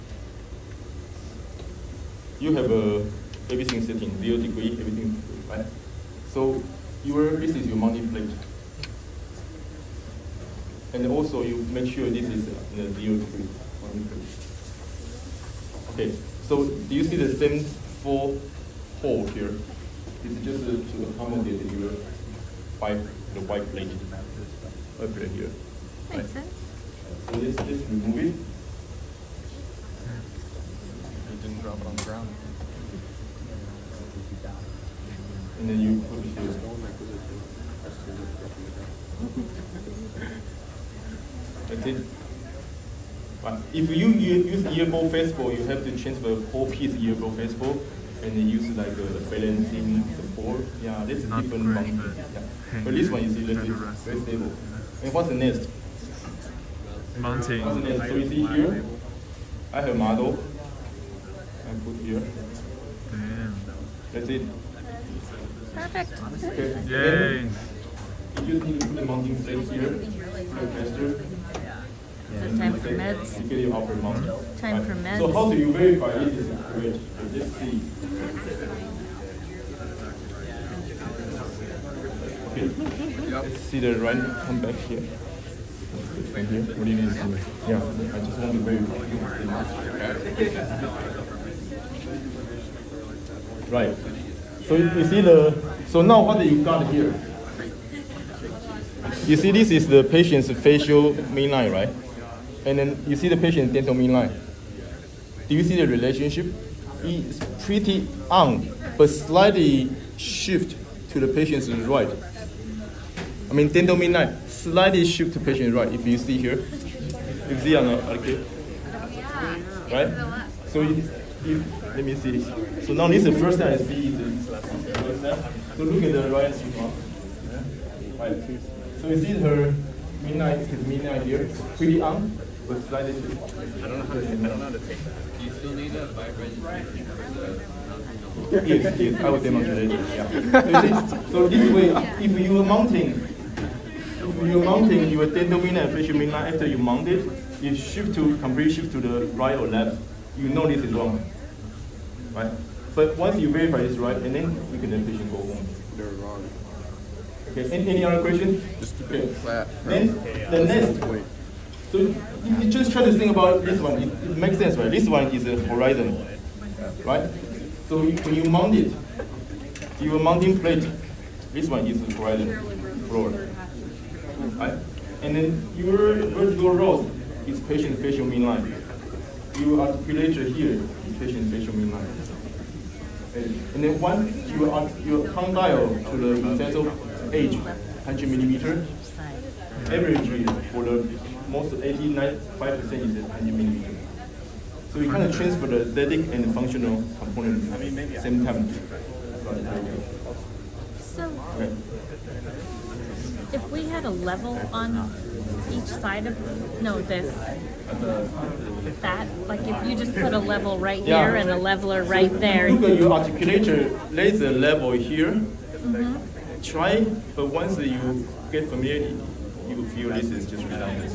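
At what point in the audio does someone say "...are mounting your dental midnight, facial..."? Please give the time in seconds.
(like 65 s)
144 s.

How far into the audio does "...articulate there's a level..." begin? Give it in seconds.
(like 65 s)
213 s.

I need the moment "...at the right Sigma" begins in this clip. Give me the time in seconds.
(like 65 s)
126 s.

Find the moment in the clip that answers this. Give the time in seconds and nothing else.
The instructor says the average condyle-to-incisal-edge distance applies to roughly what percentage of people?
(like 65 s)
191 s.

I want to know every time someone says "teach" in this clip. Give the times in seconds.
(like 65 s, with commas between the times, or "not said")
not said.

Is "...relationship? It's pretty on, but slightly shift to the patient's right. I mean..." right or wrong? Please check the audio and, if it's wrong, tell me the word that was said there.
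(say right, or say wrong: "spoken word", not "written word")
right.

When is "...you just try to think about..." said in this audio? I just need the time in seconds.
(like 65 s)
162 s.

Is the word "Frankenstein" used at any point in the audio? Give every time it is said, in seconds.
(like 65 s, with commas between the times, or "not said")
not said.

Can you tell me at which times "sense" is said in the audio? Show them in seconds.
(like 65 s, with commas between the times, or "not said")
26 s, 164 s.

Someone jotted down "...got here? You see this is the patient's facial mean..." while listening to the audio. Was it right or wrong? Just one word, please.
right.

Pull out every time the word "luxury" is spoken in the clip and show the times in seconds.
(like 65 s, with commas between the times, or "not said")
not said.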